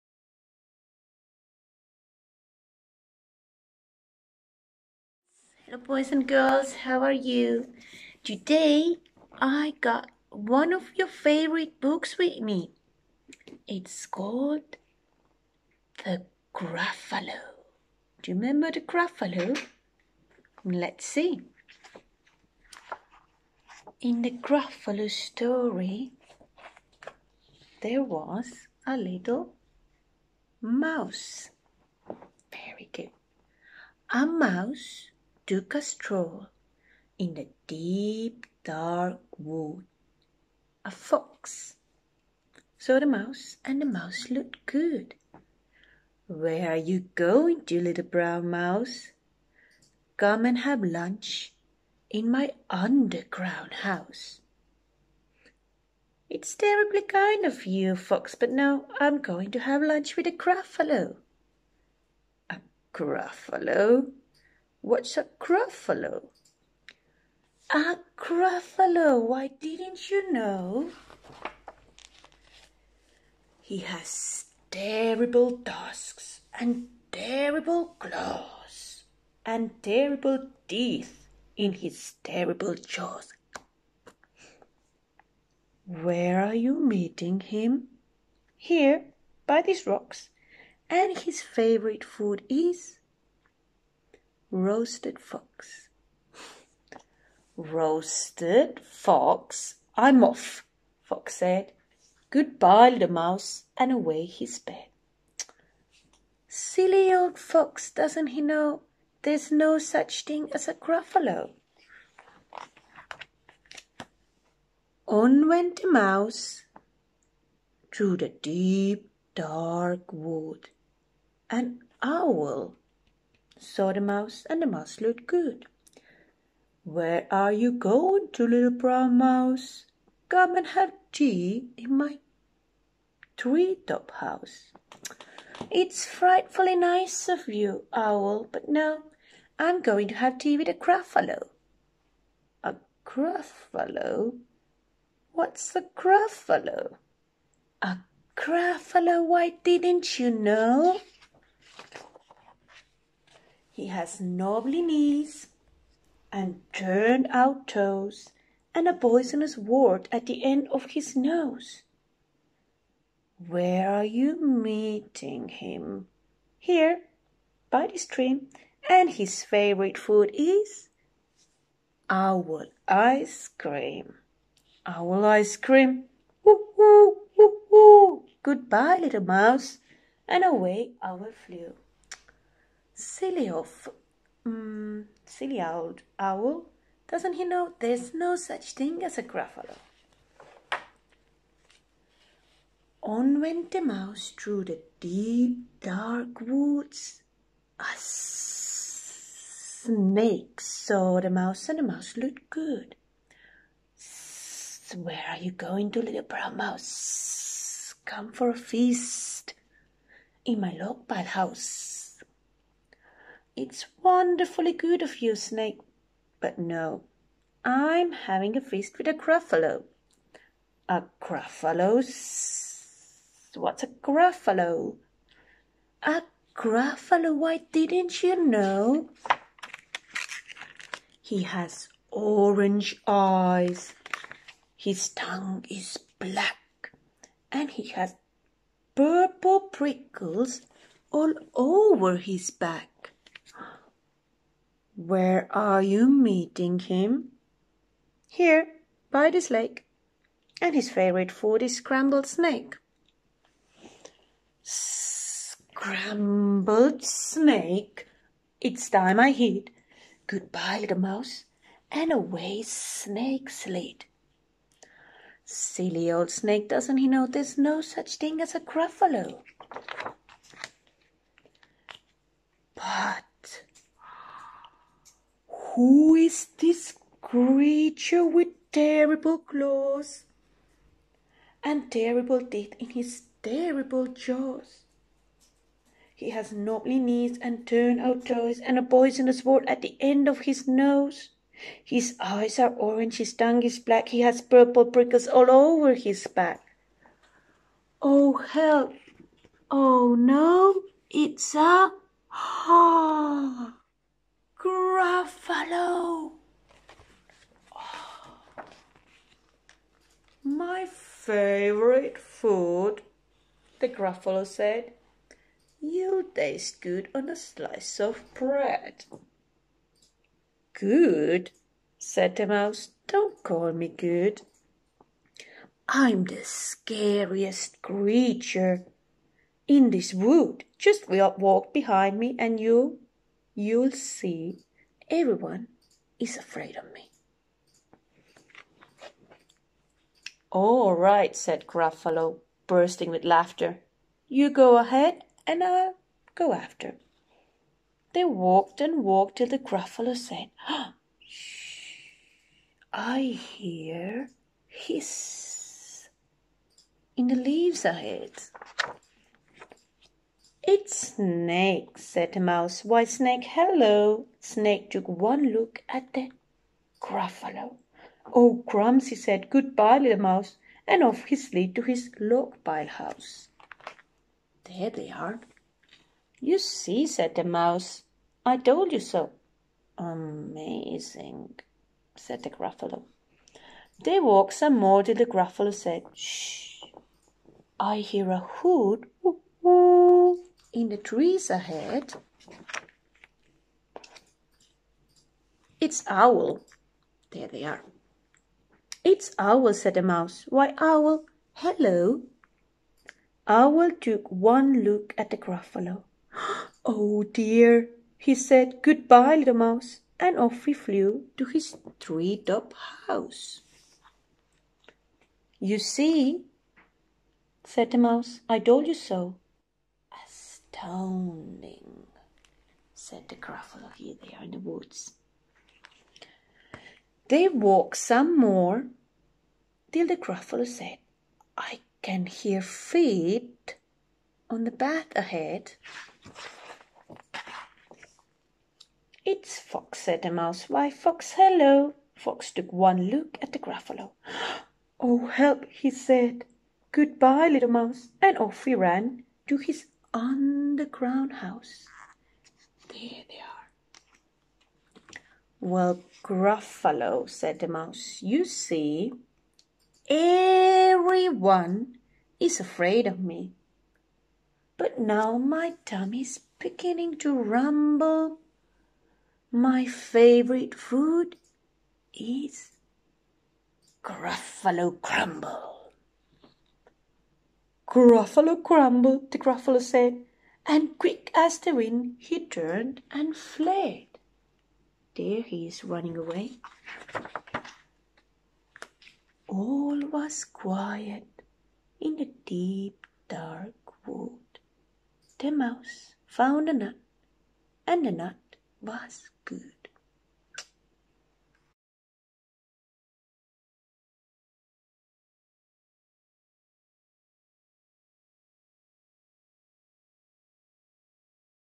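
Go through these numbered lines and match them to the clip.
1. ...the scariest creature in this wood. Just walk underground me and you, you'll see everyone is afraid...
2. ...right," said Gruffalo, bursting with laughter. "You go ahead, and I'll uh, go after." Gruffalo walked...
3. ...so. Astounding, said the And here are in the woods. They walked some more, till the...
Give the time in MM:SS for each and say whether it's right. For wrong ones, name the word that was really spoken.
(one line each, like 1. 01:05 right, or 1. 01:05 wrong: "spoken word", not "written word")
1. 05:26 wrong: "behind", not "underground"
2. 05:40 wrong: "They", not "Gruffalo"
3. 06:58 wrong: "Gruffalo", not "And".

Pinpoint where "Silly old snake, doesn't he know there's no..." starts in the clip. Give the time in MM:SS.
04:25.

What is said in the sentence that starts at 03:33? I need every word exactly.
It's wonderfully good of you, Snake, but no, I'm having a feast with a Gruffalo.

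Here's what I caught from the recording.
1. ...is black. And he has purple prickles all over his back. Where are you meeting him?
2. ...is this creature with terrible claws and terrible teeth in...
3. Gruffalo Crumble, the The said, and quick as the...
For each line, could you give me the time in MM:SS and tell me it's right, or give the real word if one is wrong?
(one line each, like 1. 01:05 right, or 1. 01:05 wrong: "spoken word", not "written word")
1. 03:55 right
2. 04:36 right
3. 07:57 wrong: "Gruffalo", not "The".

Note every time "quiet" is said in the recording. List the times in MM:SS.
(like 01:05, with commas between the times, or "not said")
08:10.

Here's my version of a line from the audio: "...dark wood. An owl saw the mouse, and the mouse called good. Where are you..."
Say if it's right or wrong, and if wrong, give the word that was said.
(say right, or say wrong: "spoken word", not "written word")
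wrong: "looked", not "called".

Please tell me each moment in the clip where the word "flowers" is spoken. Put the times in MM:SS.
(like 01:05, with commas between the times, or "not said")
not said.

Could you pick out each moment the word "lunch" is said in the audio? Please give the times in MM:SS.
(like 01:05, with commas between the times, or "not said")
00:50, 00:59.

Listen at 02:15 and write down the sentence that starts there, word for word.
It's frightfully nice of you, owl, but no, I'm going to have tea with a gruffalo.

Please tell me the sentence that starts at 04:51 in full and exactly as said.
His eyes are orange, his tongue is black, he has purple prickles all over his back.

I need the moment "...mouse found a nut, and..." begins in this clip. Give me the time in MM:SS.
08:15.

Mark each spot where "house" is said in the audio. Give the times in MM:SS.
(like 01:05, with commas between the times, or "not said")
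00:53, 02:14, 03:31, 06:12, 06:53, 07:31.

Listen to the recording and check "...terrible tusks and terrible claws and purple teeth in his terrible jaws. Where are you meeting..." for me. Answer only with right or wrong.
wrong.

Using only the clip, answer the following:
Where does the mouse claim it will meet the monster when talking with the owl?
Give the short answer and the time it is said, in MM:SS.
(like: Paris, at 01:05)
By the stream, at 02:47.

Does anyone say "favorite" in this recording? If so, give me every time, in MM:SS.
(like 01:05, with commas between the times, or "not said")
00:11, 01:31, 02:49, 04:10, 05:11, 07:49.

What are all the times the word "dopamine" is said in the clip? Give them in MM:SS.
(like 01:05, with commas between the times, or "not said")
not said.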